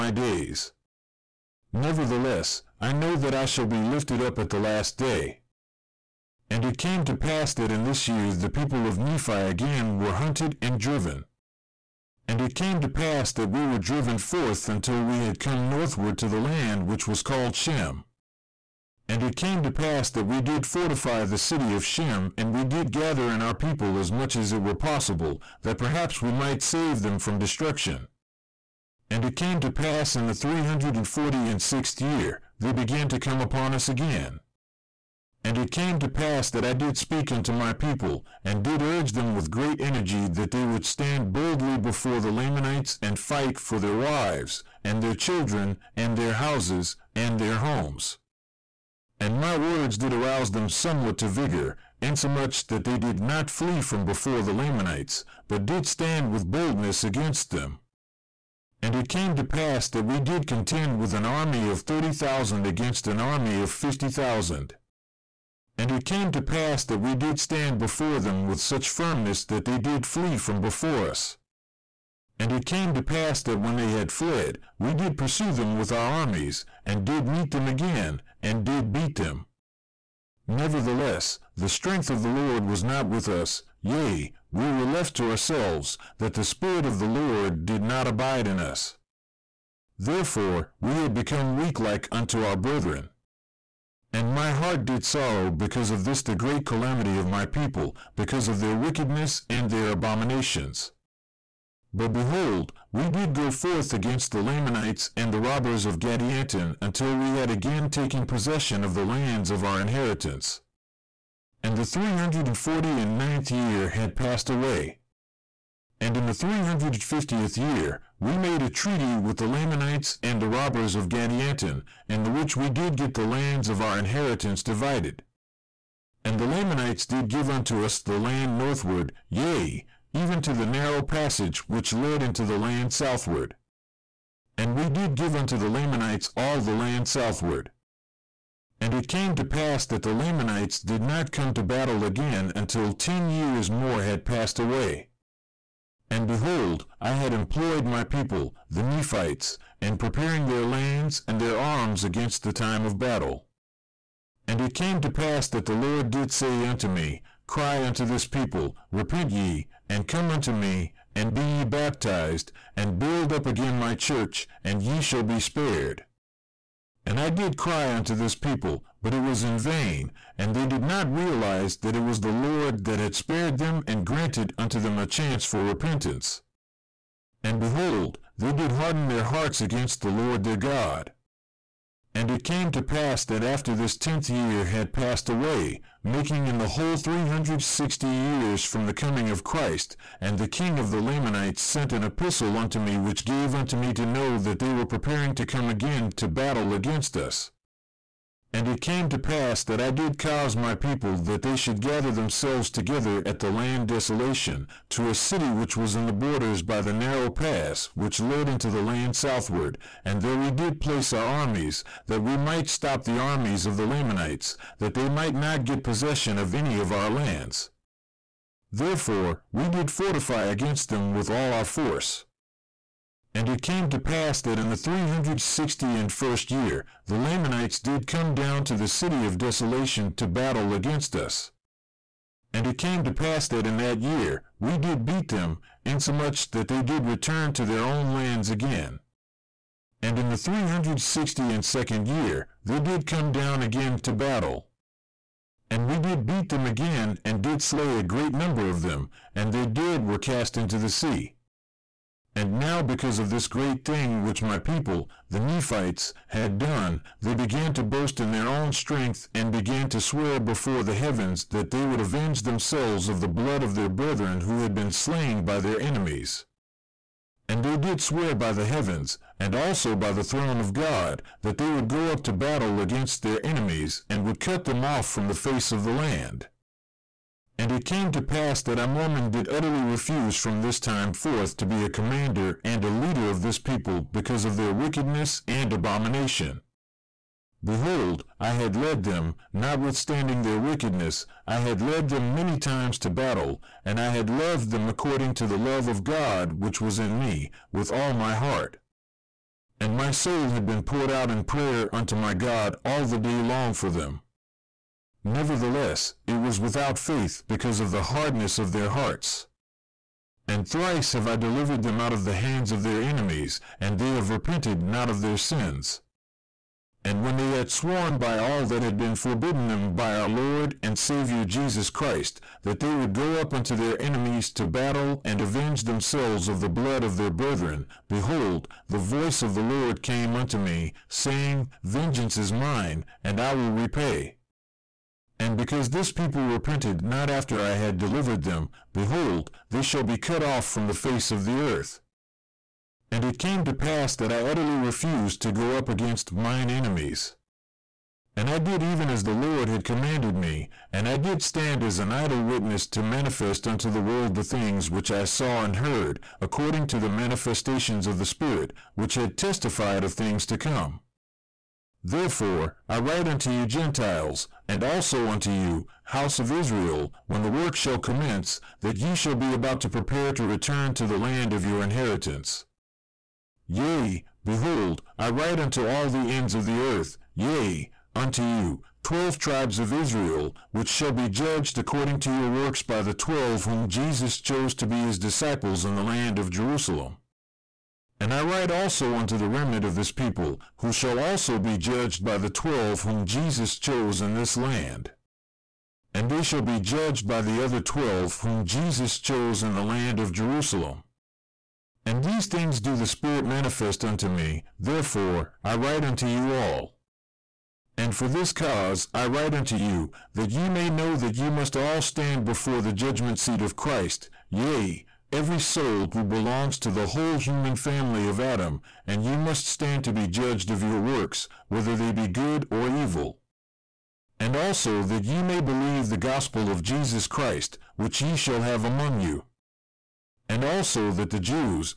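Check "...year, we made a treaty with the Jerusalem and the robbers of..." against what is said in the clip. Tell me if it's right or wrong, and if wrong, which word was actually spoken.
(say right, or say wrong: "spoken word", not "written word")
wrong: "Lamanites", not "Jerusalem".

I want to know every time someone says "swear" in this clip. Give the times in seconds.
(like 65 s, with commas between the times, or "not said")
259 s, 268 s.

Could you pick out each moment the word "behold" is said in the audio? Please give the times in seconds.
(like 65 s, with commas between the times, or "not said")
102 s, 146 s, 177 s, 287 s, 328 s, 338 s, 374 s.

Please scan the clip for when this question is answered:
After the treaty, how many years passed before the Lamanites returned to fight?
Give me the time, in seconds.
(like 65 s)
142 s.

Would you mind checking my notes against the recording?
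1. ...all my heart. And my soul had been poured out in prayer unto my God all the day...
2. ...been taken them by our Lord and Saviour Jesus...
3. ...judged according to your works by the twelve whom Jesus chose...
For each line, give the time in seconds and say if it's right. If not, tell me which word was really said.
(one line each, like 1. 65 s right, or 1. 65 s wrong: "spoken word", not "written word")
1. 297 s right
2. 318 s wrong: "forbidden", not "taken"
3. 381 s right.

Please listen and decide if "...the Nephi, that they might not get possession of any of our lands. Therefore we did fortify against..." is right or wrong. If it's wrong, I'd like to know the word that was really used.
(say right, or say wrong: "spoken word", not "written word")
wrong: "Lamanites", not "Nephi".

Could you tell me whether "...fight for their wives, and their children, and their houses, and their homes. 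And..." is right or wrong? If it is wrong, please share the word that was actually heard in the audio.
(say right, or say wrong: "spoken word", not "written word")
right.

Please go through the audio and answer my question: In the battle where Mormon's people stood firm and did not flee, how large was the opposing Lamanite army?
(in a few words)
50,000.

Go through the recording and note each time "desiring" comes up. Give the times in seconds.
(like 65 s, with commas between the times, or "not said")
not said.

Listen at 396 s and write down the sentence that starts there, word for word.
And they shall be judged by the other twelve whom Jesus chose in the land of Jerusalem.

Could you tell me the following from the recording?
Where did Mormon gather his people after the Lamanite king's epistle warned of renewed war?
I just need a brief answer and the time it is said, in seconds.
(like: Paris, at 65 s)
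The land Desolation, at 203 s.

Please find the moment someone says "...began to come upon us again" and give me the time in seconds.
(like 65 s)
32 s.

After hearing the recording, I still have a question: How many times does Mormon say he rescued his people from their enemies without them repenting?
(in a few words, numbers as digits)
3.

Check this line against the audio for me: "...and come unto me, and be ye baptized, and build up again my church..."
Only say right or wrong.
right.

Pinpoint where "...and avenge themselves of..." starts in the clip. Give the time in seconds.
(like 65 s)
325 s.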